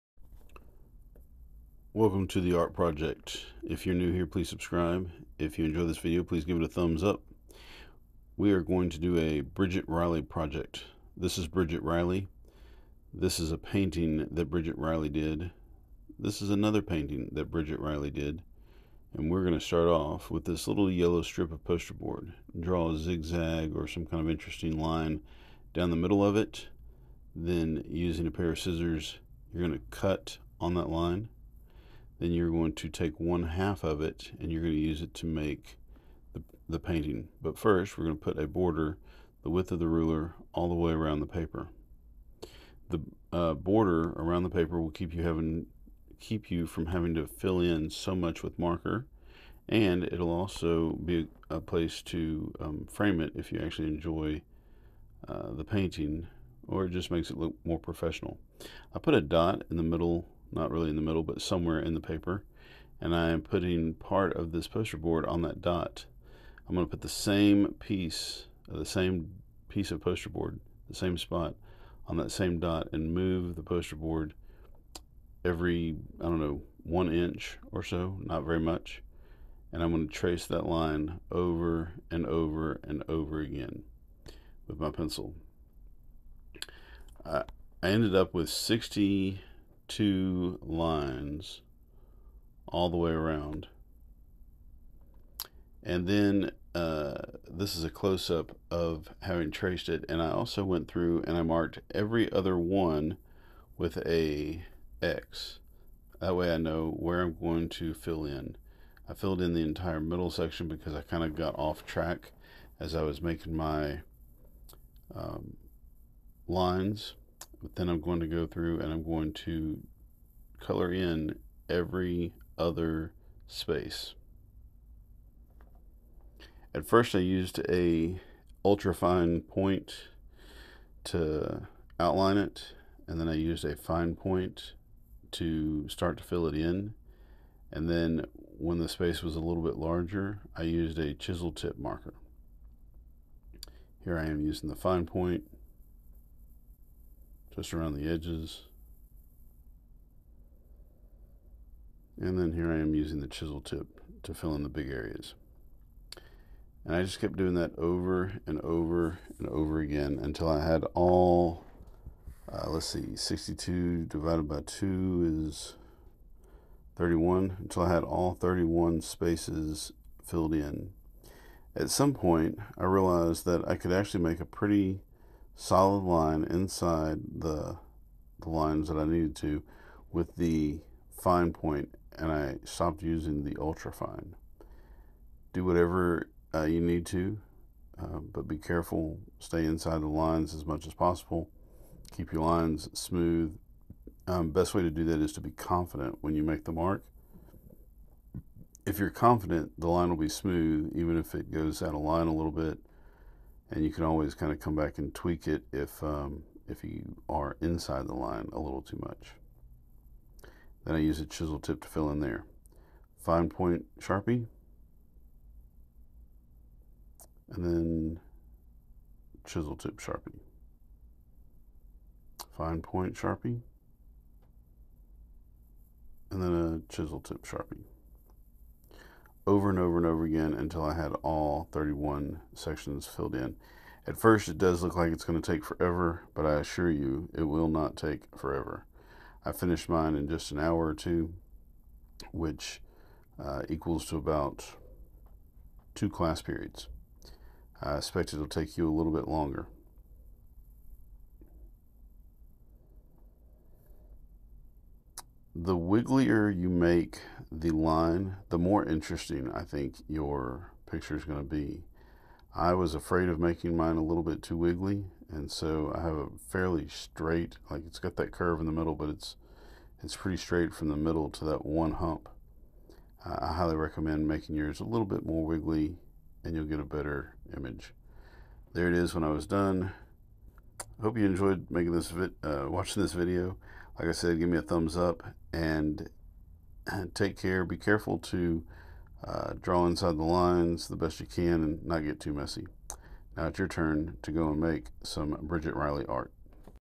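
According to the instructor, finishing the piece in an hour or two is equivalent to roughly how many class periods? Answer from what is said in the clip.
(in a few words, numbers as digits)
2.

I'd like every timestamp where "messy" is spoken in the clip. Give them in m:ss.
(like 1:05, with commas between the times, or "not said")
4:52.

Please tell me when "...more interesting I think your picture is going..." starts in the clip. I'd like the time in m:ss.
4:18.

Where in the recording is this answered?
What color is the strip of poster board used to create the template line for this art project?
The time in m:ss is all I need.
0:20.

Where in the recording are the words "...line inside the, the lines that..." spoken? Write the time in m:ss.
2:56.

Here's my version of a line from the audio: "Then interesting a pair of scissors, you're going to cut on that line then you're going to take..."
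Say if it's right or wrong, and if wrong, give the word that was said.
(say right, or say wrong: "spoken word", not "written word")
wrong: "using", not "interesting".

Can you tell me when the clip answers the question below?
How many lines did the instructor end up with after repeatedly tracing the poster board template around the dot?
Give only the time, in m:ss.
1:28.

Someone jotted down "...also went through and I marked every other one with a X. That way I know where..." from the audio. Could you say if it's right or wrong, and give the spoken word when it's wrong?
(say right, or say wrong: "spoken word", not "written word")
right.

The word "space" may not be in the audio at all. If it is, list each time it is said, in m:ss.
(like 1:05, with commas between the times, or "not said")
2:03, 2:18, 2:49.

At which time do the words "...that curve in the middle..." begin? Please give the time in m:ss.
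4:28.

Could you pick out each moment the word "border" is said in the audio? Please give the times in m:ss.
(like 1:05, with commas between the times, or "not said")
0:38, 0:43.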